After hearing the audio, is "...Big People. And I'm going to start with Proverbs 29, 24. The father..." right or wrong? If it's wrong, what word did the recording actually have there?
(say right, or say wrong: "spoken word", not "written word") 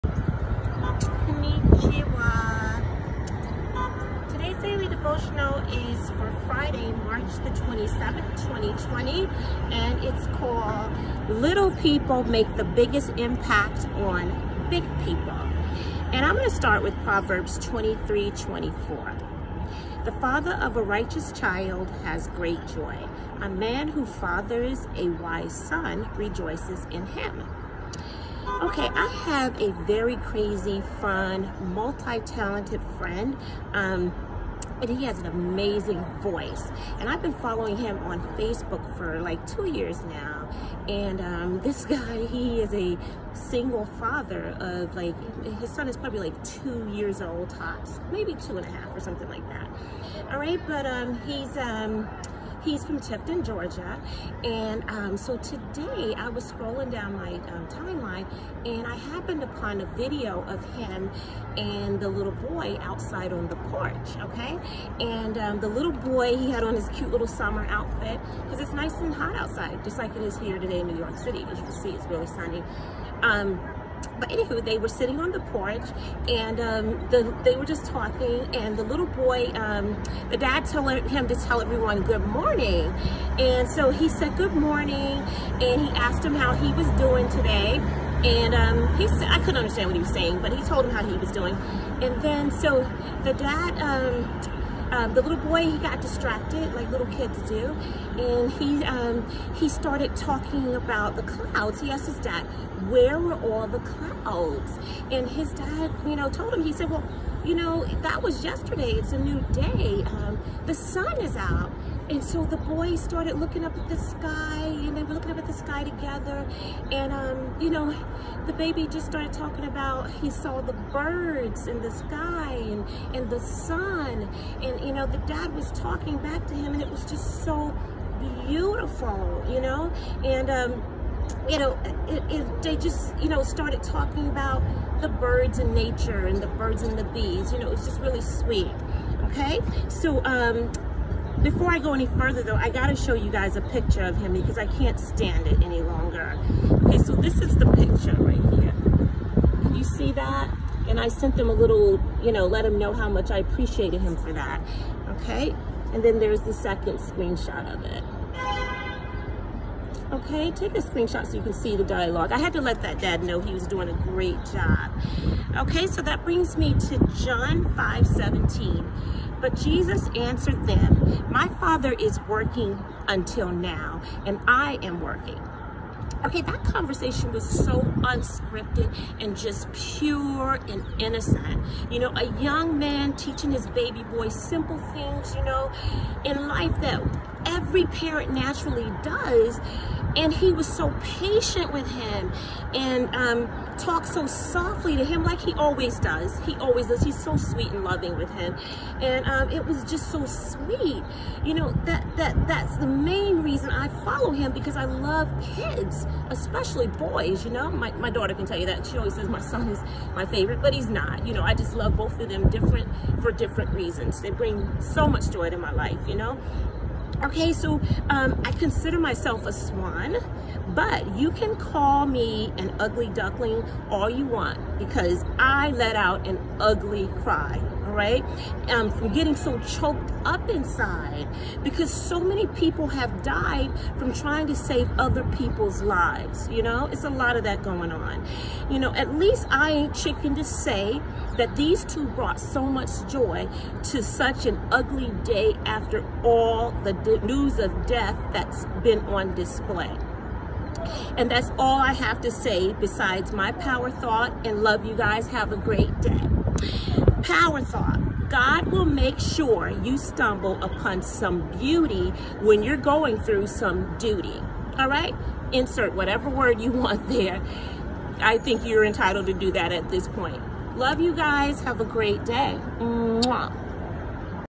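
wrong: "23", not "29".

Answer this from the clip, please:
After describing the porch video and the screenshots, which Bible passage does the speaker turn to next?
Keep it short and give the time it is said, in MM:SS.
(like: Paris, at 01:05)
John 5:17, at 02:47.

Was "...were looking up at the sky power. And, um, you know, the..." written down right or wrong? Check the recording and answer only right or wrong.
wrong.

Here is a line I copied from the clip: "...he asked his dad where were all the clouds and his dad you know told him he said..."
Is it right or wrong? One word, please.
right.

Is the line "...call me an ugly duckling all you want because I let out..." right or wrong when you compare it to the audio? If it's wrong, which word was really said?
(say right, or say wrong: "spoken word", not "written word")
right.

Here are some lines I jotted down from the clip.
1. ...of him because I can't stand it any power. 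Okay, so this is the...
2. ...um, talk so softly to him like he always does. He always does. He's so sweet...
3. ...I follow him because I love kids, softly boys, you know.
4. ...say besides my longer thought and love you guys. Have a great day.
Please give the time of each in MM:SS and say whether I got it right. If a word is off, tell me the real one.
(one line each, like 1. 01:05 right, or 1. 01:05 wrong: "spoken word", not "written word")
1. 02:24 wrong: "longer", not "power"
2. 03:13 right
3. 03:23 wrong: "especially", not "softly"
4. 04:12 wrong: "power", not "longer".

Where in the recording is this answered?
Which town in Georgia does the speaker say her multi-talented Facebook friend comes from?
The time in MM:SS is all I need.
00:52.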